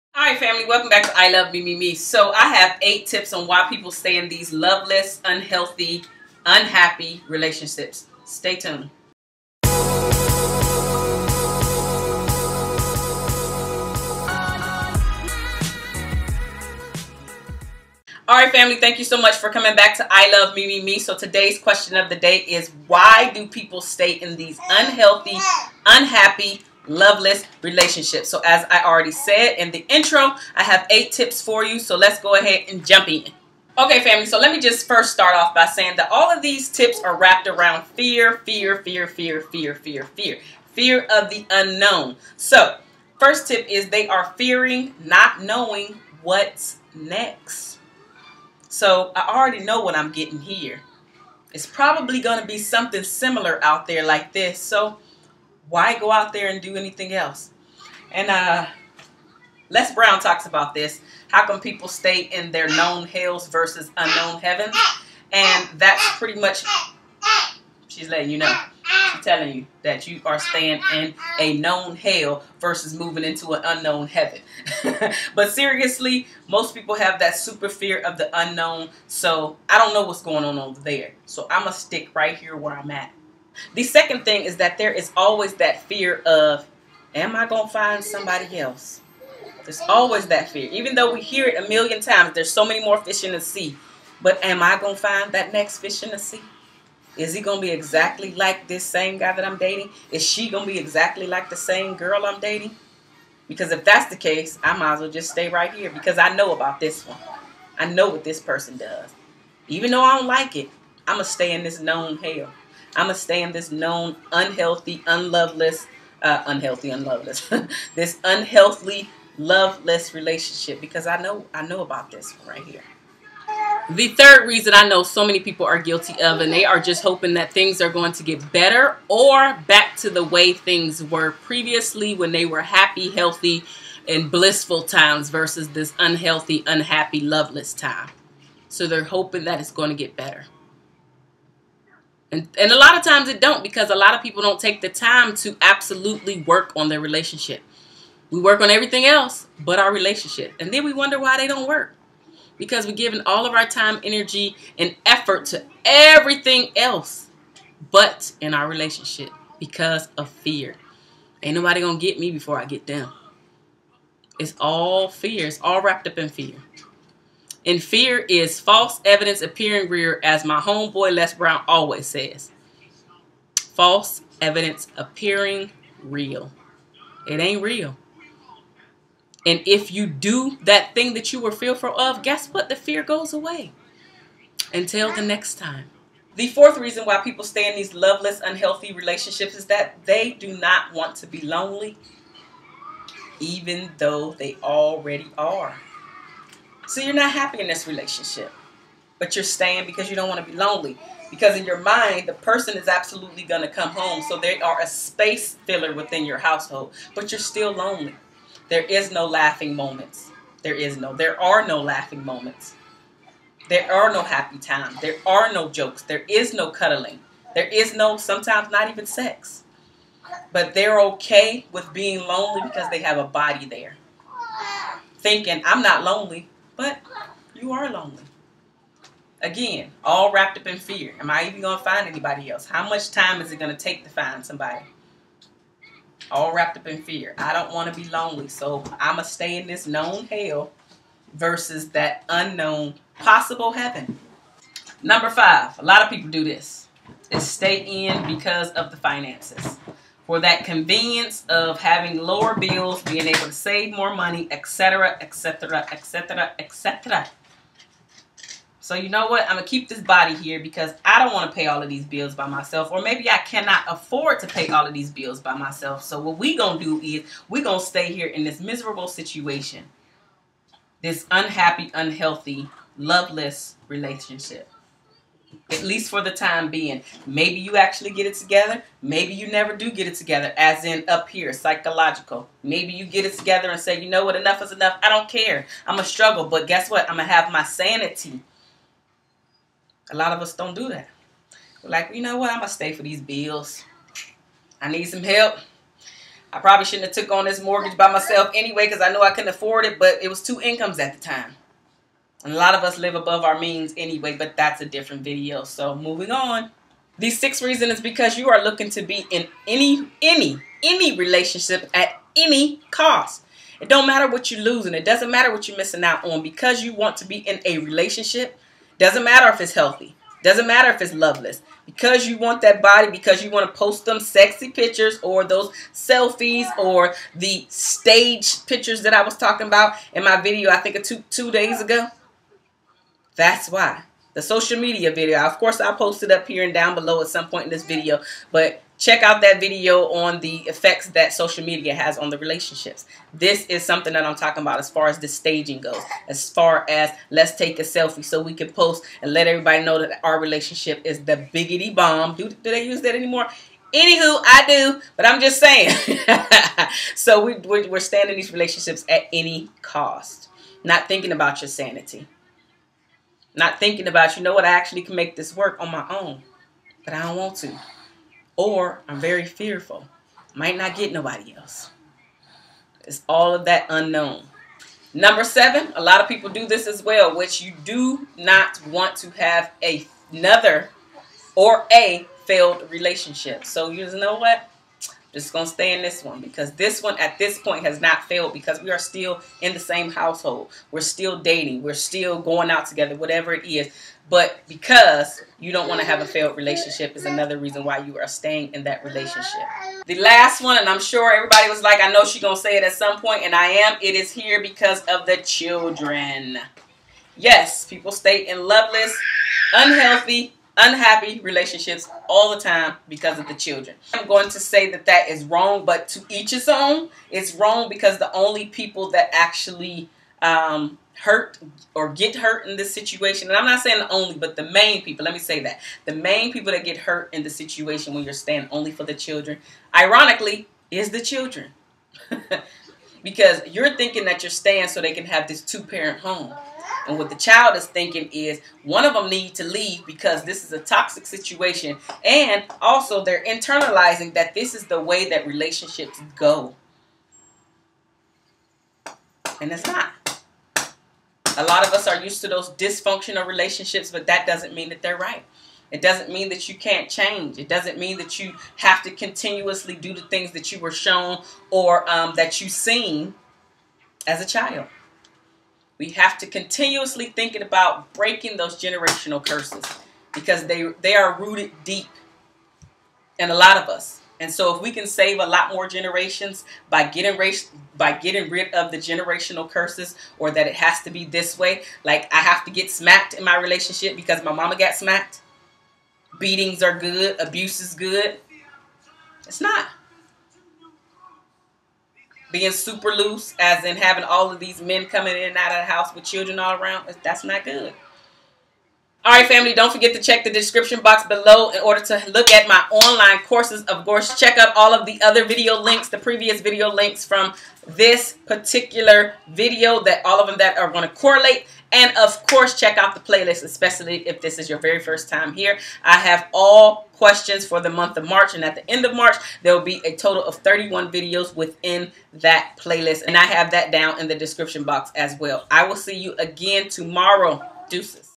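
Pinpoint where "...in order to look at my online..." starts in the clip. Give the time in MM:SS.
08:21.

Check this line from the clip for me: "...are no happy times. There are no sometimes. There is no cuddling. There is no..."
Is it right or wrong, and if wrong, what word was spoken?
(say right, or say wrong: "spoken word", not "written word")
wrong: "jokes", not "sometimes".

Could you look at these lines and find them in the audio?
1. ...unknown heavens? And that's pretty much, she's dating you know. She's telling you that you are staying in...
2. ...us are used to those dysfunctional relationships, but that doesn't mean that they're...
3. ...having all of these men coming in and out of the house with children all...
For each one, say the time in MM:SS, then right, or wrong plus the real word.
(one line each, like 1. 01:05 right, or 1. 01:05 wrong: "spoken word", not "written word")
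1. 01:03 wrong: "letting", not "dating"
2. 07:31 right
3. 08:13 right.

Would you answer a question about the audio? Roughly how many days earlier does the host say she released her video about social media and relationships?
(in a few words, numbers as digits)
2.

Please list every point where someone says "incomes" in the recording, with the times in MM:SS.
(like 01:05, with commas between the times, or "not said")
05:00.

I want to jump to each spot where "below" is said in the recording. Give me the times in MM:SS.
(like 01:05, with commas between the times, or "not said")
05:36, 08:21.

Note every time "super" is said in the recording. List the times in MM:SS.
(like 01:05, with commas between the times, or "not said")
01:17, 08:12.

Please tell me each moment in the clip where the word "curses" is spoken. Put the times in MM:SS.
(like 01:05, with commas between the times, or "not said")
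07:49, 07:59.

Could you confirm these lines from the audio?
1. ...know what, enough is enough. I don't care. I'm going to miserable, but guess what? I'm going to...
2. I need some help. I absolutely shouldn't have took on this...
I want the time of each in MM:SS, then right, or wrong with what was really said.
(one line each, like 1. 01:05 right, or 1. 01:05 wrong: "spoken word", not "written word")
1. 04:44 wrong: "struggle", not "miserable"
2. 04:54 wrong: "probably", not "absolutely".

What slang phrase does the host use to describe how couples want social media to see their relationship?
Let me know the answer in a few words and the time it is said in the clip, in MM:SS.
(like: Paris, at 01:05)
the biggity bomb, at 05:51.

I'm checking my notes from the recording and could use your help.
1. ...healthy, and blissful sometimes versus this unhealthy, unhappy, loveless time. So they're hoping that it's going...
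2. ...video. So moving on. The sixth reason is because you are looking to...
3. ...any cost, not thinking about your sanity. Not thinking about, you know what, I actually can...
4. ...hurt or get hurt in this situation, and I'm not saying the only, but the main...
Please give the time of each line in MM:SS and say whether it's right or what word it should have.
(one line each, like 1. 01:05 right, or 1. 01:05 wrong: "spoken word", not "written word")
1. 02:13 wrong: "times", not "sometimes"
2. 05:05 right
3. 05:59 right
4. 07:01 right.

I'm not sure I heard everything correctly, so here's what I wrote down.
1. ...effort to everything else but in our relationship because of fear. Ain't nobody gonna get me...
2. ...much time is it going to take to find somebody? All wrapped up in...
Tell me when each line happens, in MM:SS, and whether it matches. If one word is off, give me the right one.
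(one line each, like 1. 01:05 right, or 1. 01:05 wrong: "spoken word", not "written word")
1. 02:35 right
2. 03:52 right.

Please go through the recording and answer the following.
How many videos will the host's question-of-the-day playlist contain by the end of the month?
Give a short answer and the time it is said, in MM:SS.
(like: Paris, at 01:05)
31, at 08:40.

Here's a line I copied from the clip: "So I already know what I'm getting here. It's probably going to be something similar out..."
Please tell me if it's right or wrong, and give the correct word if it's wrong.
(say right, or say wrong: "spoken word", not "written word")
right.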